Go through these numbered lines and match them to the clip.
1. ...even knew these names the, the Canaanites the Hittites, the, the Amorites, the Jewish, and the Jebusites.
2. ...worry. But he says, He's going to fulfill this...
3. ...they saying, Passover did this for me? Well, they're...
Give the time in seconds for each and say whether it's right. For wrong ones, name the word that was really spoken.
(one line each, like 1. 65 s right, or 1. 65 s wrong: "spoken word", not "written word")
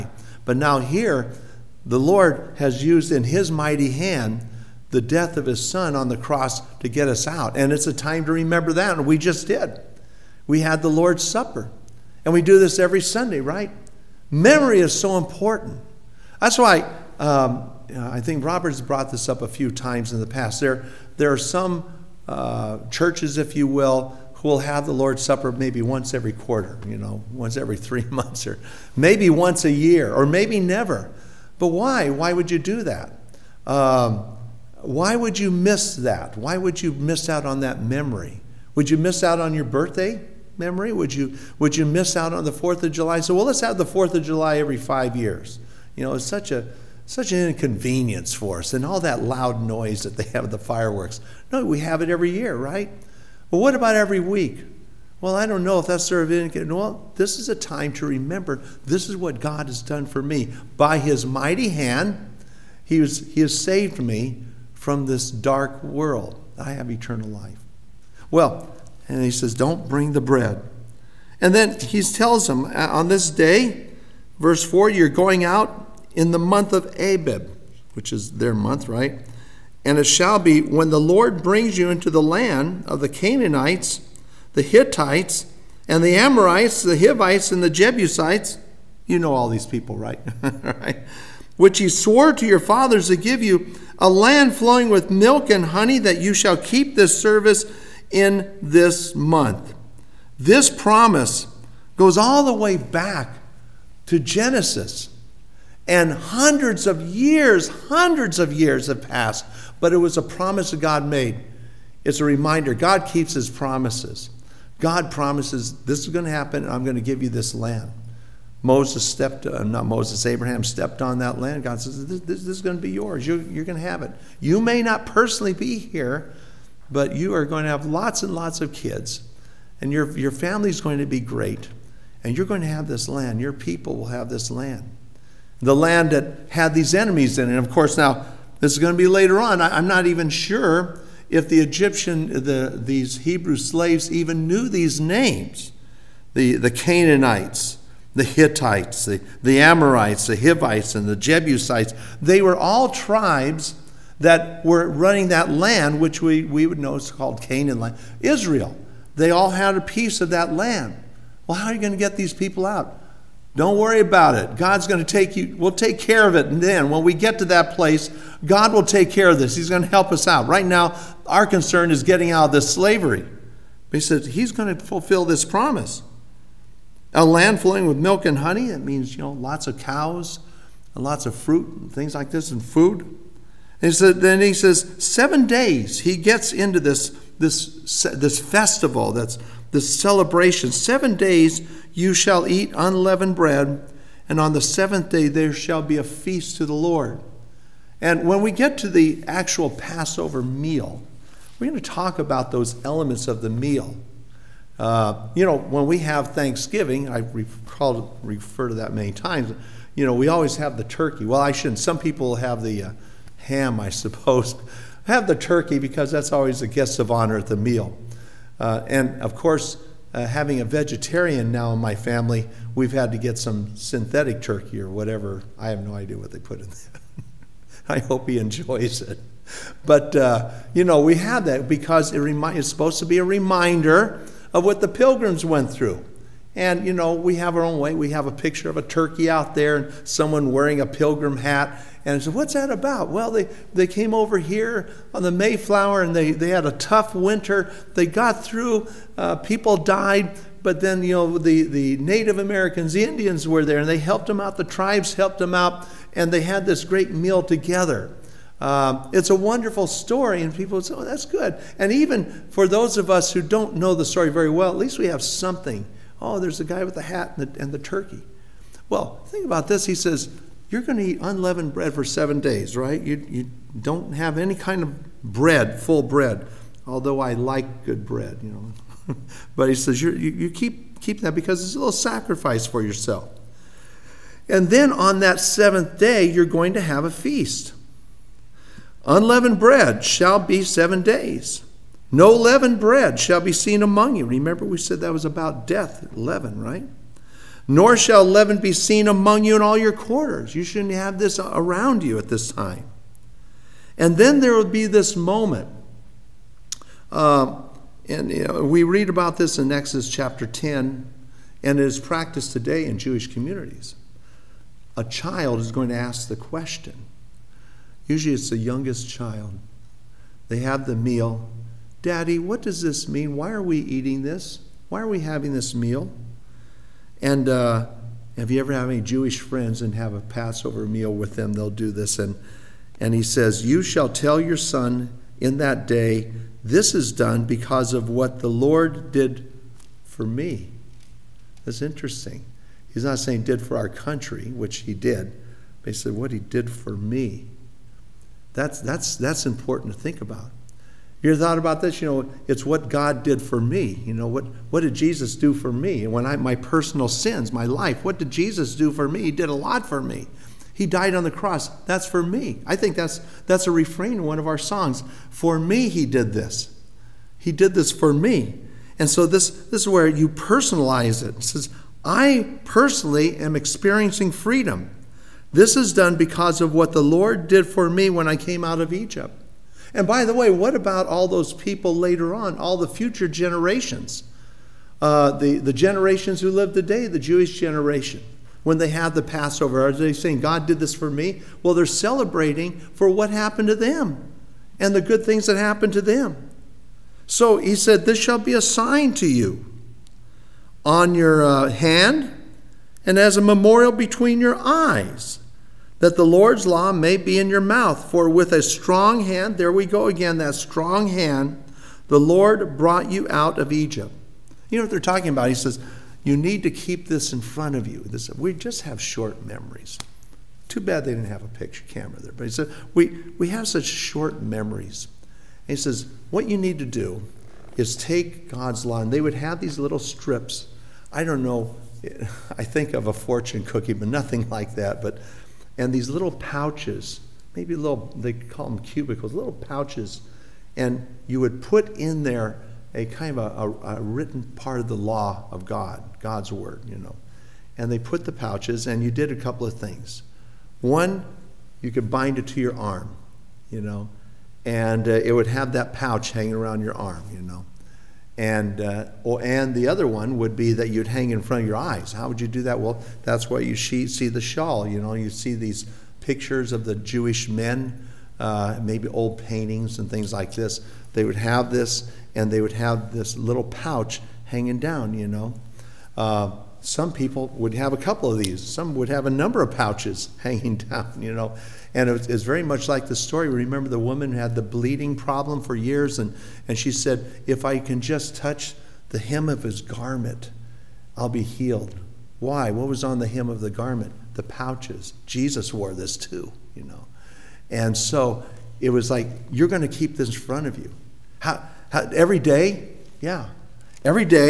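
1. 144 s wrong: "Hivites", not "Jewish"
2. 172 s wrong: "slavery", not "worry"
3. 389 s wrong: "God", not "Passover".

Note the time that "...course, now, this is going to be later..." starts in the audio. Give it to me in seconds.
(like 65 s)
137 s.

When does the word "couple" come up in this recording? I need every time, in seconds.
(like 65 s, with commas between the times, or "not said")
449 s, 477 s.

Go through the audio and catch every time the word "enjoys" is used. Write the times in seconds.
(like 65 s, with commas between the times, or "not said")
228 s.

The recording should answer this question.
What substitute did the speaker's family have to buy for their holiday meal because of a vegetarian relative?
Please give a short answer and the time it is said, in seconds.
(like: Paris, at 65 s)
synthetic turkey, at 223 s.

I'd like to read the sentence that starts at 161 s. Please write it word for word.
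Well, how are you going to get these people out?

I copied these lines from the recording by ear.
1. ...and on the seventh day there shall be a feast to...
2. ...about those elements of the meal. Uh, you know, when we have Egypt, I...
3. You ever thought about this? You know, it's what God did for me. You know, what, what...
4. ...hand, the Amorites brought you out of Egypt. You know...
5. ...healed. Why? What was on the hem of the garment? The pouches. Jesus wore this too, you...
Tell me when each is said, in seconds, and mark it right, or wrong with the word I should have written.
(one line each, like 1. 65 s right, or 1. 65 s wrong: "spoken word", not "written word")
1. 194 s right
2. 202 s wrong: "Thanksgiving", not "Egypt"
3. 351 s right
4. 411 s wrong: "Lord", not "Amorites"
5. 491 s right.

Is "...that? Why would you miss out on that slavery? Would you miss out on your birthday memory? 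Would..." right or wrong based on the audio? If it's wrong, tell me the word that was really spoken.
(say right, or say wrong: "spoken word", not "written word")
wrong: "memory", not "slavery".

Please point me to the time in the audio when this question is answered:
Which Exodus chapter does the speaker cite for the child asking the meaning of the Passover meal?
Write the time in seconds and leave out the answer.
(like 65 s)
310 s.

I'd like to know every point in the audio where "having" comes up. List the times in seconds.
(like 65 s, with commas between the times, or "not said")
220 s, 325 s.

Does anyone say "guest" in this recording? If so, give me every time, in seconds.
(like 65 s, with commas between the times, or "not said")
216 s.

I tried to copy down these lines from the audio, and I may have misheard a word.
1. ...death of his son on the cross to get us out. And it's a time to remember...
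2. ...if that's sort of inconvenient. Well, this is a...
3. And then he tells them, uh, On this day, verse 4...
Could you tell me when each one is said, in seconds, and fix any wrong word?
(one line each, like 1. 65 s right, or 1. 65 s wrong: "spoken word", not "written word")
1. 5 s right
2. 55 s right
3. 71 s right.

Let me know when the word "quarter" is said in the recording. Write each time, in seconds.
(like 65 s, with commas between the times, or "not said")
26 s, 299 s.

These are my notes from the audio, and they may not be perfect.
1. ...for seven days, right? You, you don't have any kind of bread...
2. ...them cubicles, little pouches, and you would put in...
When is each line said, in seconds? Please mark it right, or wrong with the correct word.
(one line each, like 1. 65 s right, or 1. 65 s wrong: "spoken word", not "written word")
1. 271 s right
2. 438 s right.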